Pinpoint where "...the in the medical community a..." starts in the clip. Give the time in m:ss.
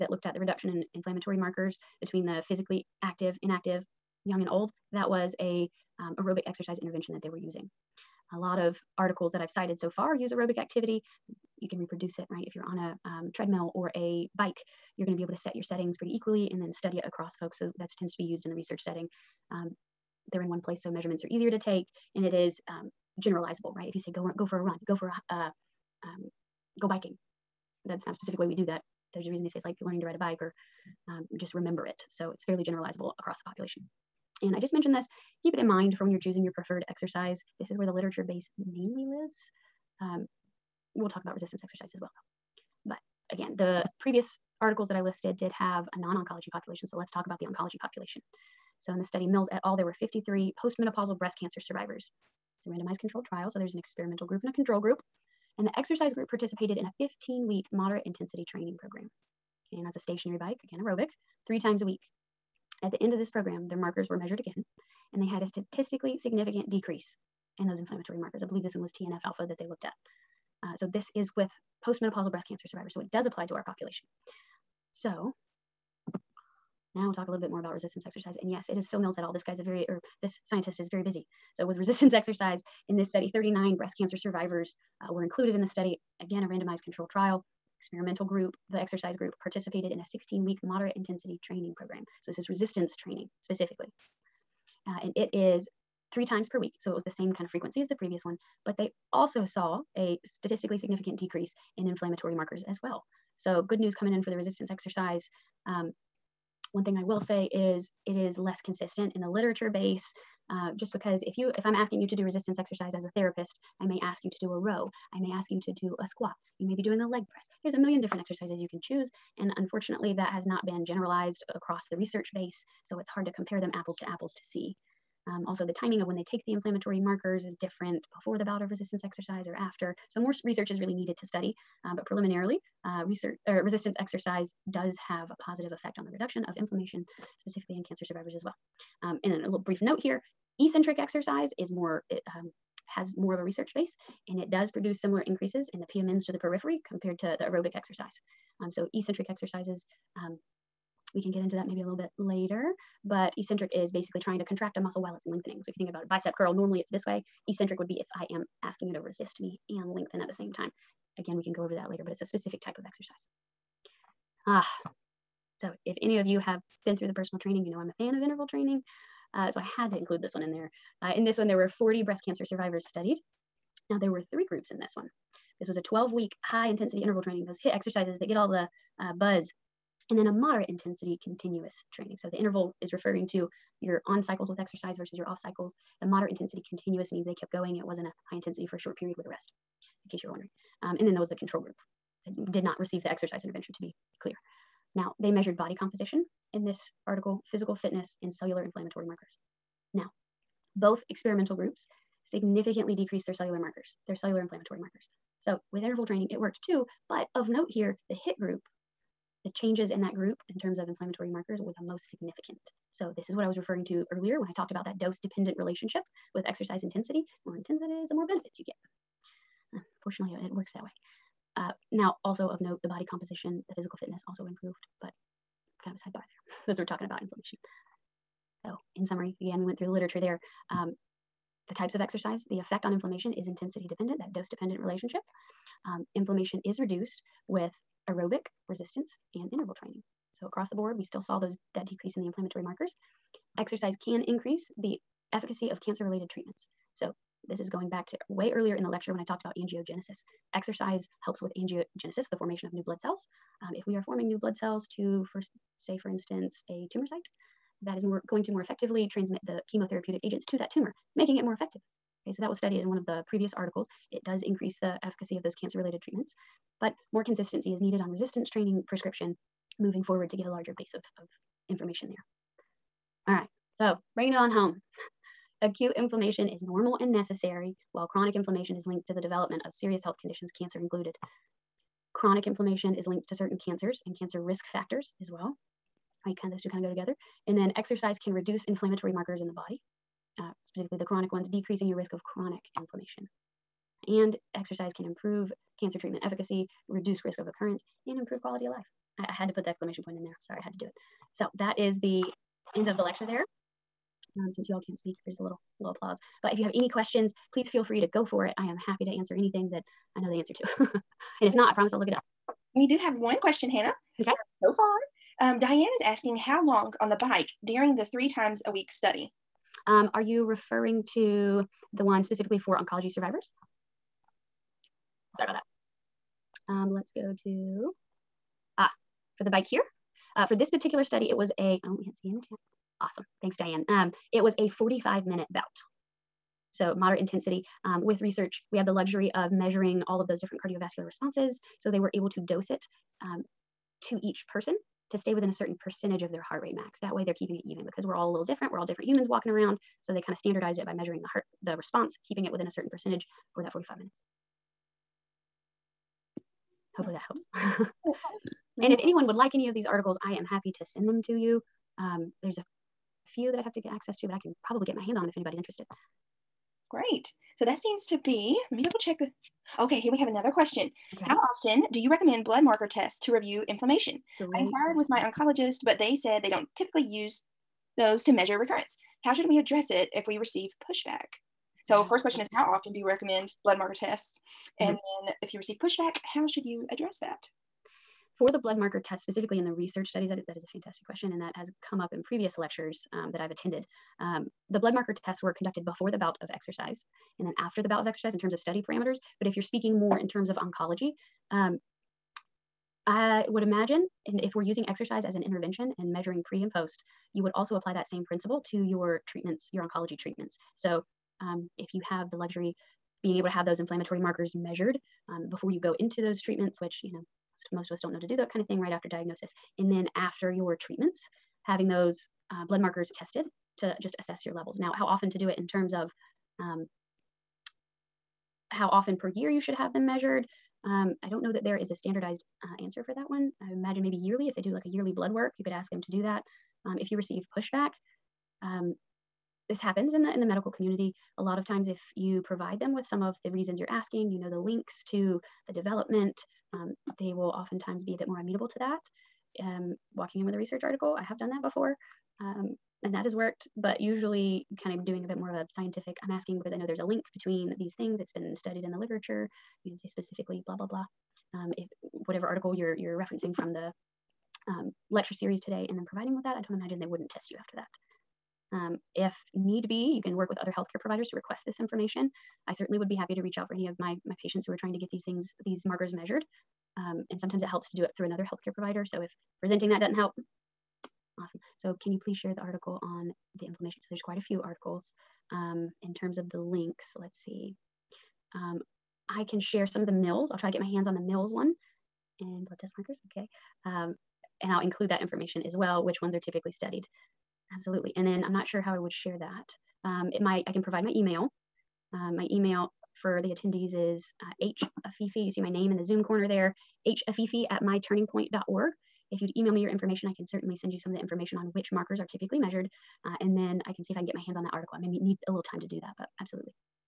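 7:20.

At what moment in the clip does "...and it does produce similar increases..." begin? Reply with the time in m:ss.
2:24.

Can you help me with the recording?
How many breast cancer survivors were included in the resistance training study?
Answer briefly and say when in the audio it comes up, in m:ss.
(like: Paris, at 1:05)
39, at 1:23.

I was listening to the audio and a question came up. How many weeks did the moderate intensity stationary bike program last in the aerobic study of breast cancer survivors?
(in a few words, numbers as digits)
15.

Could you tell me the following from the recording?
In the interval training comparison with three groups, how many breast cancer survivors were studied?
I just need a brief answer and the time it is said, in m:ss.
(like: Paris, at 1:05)
40, at 2:51.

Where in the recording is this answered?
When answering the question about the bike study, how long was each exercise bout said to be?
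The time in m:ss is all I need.
5:34.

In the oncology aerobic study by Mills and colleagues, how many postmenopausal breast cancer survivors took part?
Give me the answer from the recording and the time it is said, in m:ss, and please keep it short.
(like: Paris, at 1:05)
53, at 0:50.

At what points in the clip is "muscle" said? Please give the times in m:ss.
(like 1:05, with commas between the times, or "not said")
2:34.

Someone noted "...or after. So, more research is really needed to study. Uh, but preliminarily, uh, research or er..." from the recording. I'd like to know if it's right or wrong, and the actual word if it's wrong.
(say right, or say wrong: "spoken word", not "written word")
right.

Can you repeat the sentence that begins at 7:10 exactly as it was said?
Um, I don't know that there is a standardized uh, answer for that one.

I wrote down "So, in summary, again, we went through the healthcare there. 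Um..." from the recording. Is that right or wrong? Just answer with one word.
wrong.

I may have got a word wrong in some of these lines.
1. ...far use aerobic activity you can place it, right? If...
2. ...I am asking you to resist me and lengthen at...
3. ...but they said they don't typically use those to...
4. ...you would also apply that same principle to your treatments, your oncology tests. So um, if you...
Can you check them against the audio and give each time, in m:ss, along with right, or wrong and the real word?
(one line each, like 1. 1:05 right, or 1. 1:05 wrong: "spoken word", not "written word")
1. 0:09 wrong: "reproduce", not "place"
2. 2:38 right
3. 6:15 right
4. 6:47 wrong: "treatments", not "tests".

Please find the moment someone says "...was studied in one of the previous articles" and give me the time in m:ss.
4:22.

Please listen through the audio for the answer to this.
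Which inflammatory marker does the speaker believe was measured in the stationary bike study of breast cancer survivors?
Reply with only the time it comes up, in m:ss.
1:08.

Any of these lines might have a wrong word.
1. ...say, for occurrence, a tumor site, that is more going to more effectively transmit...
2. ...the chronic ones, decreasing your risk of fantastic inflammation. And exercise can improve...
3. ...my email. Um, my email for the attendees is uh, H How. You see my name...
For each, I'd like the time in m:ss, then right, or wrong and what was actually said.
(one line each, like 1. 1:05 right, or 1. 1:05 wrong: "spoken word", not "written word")
1. 4:15 wrong: "instance", not "occurrence"
2. 4:50 wrong: "chronic", not "fantastic"
3. 8:21 wrong: "Afify", not "How".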